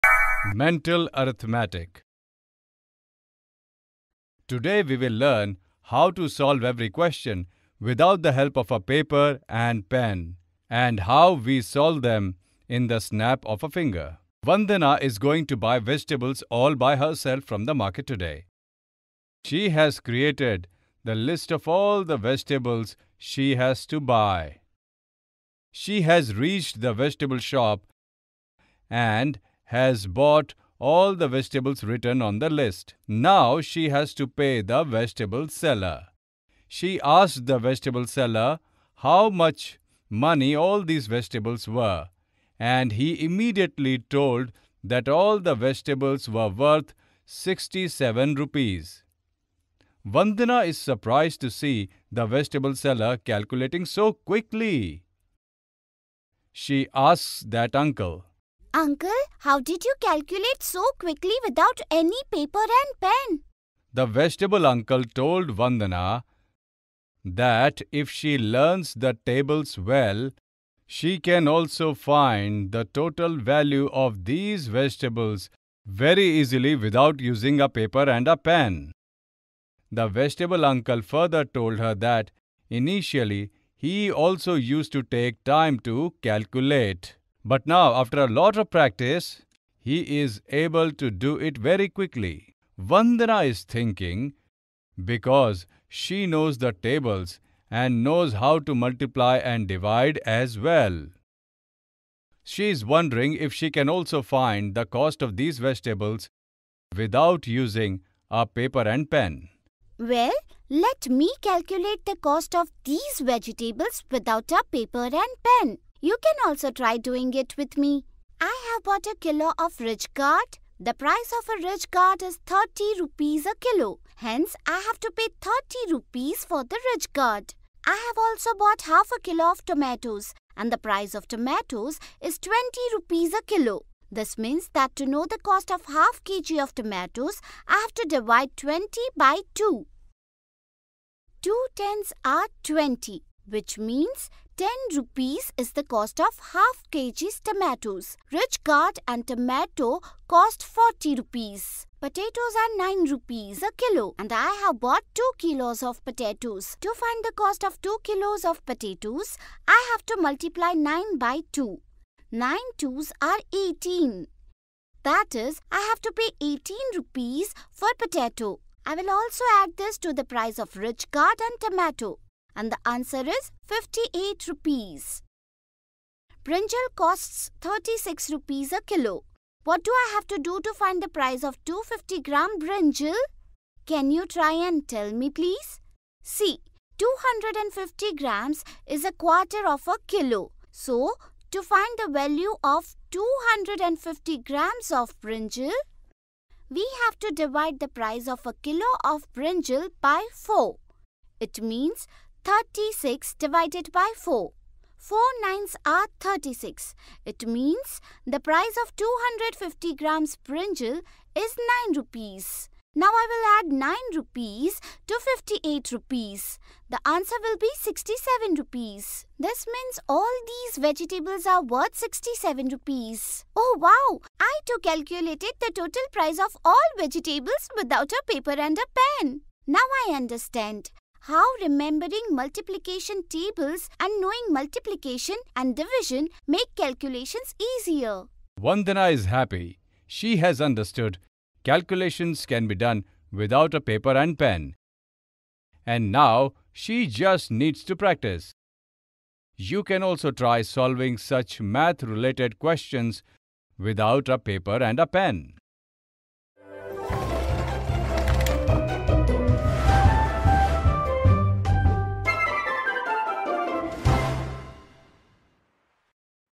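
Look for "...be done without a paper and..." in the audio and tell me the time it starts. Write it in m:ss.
4:02.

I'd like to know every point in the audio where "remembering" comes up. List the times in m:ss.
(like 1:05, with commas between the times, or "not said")
3:51.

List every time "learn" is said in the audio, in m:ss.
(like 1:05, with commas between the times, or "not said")
0:05, 1:08.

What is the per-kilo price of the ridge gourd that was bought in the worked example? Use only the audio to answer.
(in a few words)
30 rupees.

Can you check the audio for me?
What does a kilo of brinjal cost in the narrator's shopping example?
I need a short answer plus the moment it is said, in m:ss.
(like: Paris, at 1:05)
36 rupees, at 2:57.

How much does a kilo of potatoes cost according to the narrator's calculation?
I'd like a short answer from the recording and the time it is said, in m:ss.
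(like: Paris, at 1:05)
9 rupees, at 2:32.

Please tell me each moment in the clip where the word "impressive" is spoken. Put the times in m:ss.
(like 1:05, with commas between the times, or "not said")
not said.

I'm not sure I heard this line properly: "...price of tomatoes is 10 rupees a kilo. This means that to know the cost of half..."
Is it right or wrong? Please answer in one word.
wrong.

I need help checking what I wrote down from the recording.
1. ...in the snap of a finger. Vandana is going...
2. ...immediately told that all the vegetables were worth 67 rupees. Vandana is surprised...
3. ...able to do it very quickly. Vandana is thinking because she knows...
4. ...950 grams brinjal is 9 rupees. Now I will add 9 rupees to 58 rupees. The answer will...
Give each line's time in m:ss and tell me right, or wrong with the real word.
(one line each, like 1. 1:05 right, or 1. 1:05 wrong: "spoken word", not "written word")
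1. 0:12 right
2. 0:43 right
3. 1:30 right
4. 3:28 wrong: "250", not "950".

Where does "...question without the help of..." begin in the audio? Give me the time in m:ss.
0:06.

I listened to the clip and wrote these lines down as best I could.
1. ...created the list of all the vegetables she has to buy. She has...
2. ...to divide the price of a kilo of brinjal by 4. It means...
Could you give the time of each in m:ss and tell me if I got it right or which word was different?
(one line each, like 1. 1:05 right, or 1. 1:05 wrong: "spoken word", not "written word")
1. 0:19 right
2. 3:17 right.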